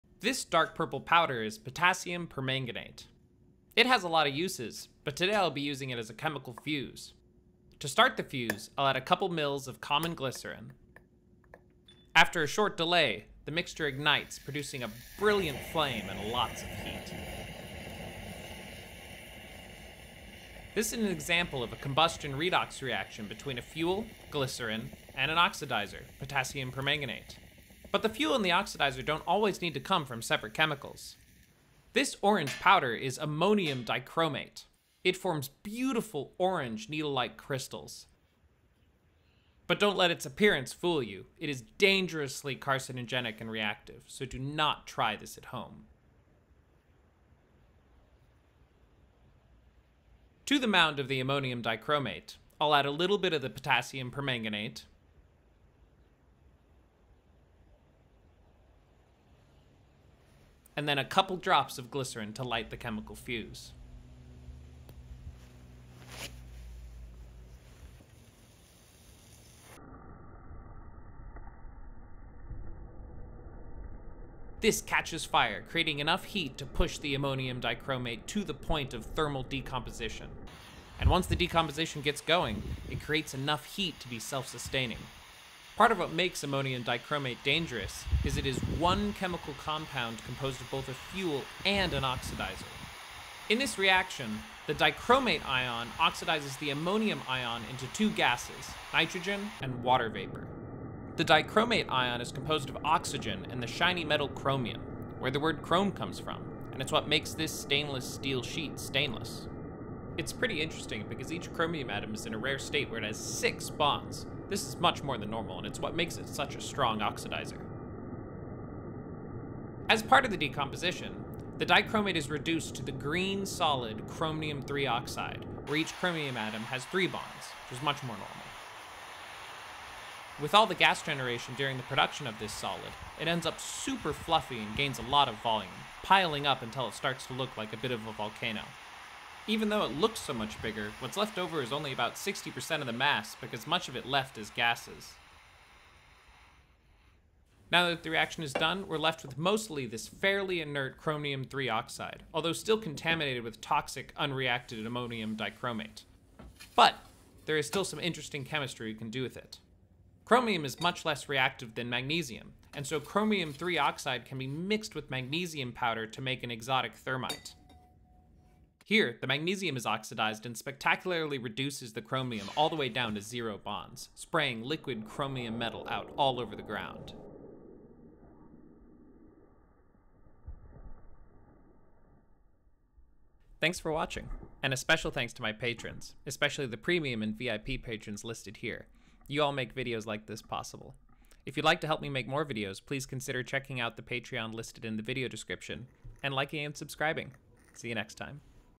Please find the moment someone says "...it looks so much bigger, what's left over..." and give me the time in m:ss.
2:19.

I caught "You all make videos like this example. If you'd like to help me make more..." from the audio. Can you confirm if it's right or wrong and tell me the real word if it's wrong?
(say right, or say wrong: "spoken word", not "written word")
wrong: "possible", not "example".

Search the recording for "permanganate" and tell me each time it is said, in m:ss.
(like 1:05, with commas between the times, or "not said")
0:02, 0:26, 0:54.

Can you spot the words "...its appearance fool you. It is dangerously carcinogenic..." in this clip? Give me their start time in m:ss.
0:40.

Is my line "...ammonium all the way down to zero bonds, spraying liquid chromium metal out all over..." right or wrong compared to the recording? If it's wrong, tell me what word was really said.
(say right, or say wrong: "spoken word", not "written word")
wrong: "chromium", not "ammonium".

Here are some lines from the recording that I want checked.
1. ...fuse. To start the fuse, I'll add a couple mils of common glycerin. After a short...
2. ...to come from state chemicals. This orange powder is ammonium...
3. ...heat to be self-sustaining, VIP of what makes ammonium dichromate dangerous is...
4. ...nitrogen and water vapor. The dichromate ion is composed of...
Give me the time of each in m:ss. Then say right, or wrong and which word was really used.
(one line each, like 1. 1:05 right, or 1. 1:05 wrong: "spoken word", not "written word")
1. 0:06 right
2. 0:29 wrong: "separate", not "state"
3. 1:23 wrong: "Part", not "VIP"
4. 1:38 right.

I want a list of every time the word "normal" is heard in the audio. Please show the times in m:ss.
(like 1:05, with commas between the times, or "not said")
1:55, 2:08.